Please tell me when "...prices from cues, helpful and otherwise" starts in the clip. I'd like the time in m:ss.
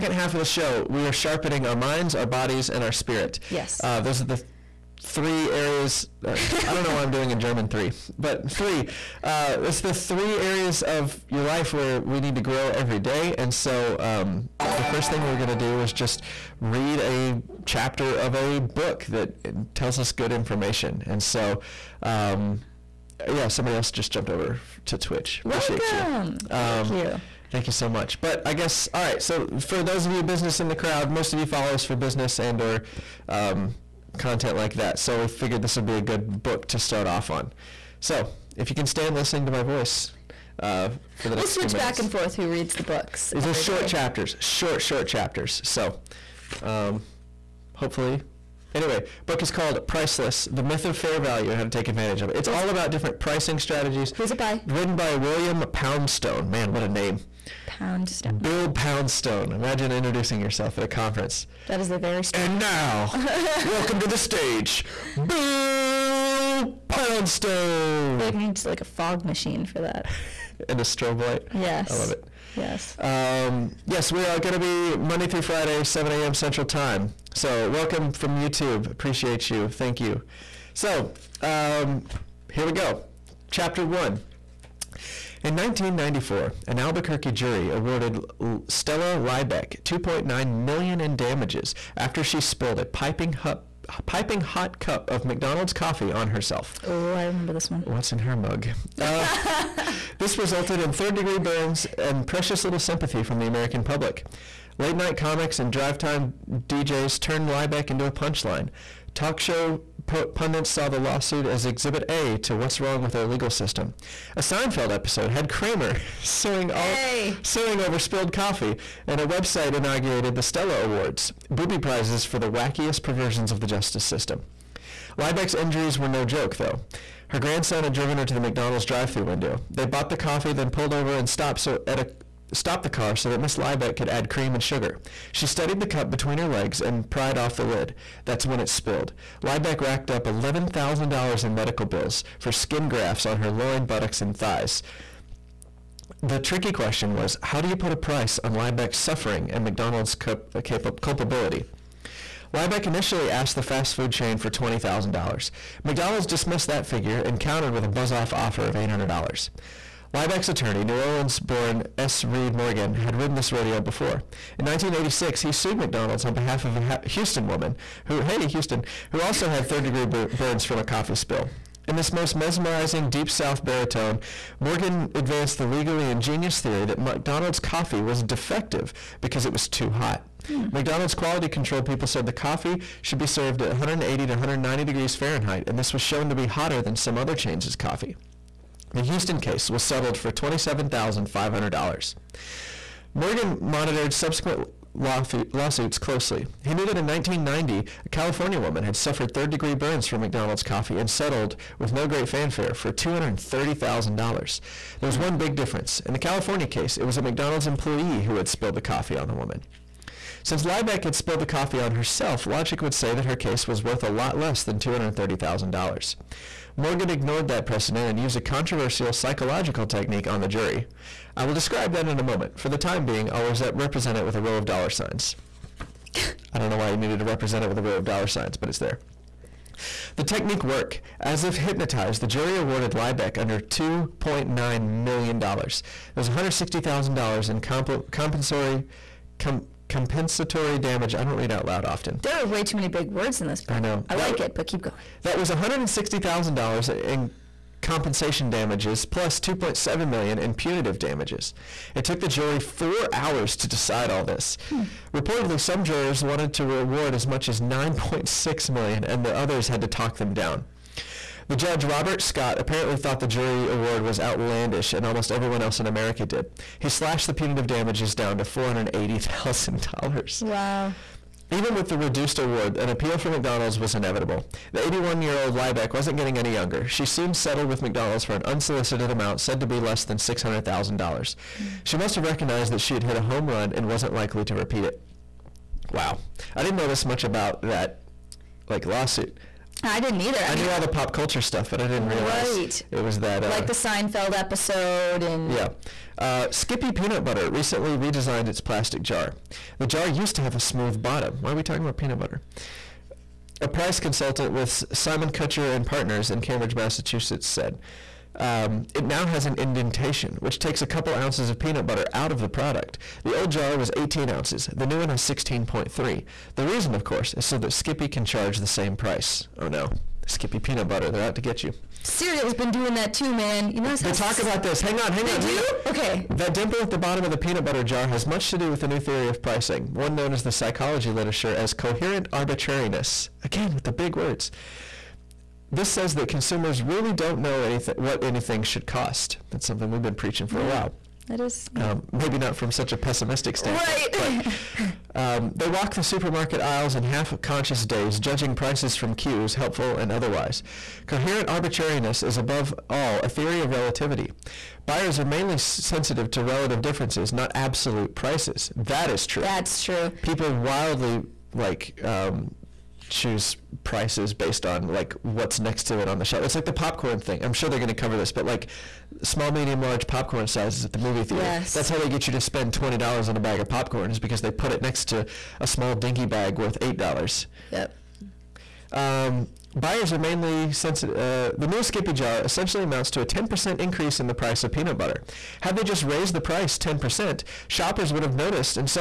5:48.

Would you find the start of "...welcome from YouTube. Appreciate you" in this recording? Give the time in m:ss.
1:17.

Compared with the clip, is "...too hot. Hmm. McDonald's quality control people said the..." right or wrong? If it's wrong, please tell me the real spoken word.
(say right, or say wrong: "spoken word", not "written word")
right.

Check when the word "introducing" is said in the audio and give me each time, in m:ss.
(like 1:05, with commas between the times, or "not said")
0:59.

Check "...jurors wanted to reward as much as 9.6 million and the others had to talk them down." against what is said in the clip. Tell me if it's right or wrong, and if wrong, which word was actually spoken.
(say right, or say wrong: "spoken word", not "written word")
right.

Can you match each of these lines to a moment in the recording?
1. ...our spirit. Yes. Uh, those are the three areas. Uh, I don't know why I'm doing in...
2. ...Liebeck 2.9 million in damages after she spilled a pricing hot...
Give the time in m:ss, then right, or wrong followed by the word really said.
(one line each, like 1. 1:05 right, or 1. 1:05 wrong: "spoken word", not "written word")
1. 0:02 right
2. 1:29 wrong: "piping", not "pricing".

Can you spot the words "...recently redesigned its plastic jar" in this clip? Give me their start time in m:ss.
4:57.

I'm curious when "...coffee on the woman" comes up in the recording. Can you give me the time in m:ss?
3:28.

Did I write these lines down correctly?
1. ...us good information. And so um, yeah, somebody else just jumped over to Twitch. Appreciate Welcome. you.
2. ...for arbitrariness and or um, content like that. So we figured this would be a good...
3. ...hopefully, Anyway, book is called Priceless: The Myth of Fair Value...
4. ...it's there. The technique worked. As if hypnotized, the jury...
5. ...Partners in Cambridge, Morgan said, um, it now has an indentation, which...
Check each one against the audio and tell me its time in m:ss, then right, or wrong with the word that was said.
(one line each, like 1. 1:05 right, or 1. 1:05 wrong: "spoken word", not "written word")
1. 0:19 right
2. 0:31 wrong: "business", not "arbitrariness"
3. 0:47 right
4. 3:48 right
5. 5:05 wrong: "Massachusetts", not "Morgan".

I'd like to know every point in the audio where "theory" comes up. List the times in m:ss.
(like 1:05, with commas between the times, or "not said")
2:56, 5:28, 5:53.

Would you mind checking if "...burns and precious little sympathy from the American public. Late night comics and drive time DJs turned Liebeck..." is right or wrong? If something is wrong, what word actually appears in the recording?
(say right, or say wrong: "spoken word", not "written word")
right.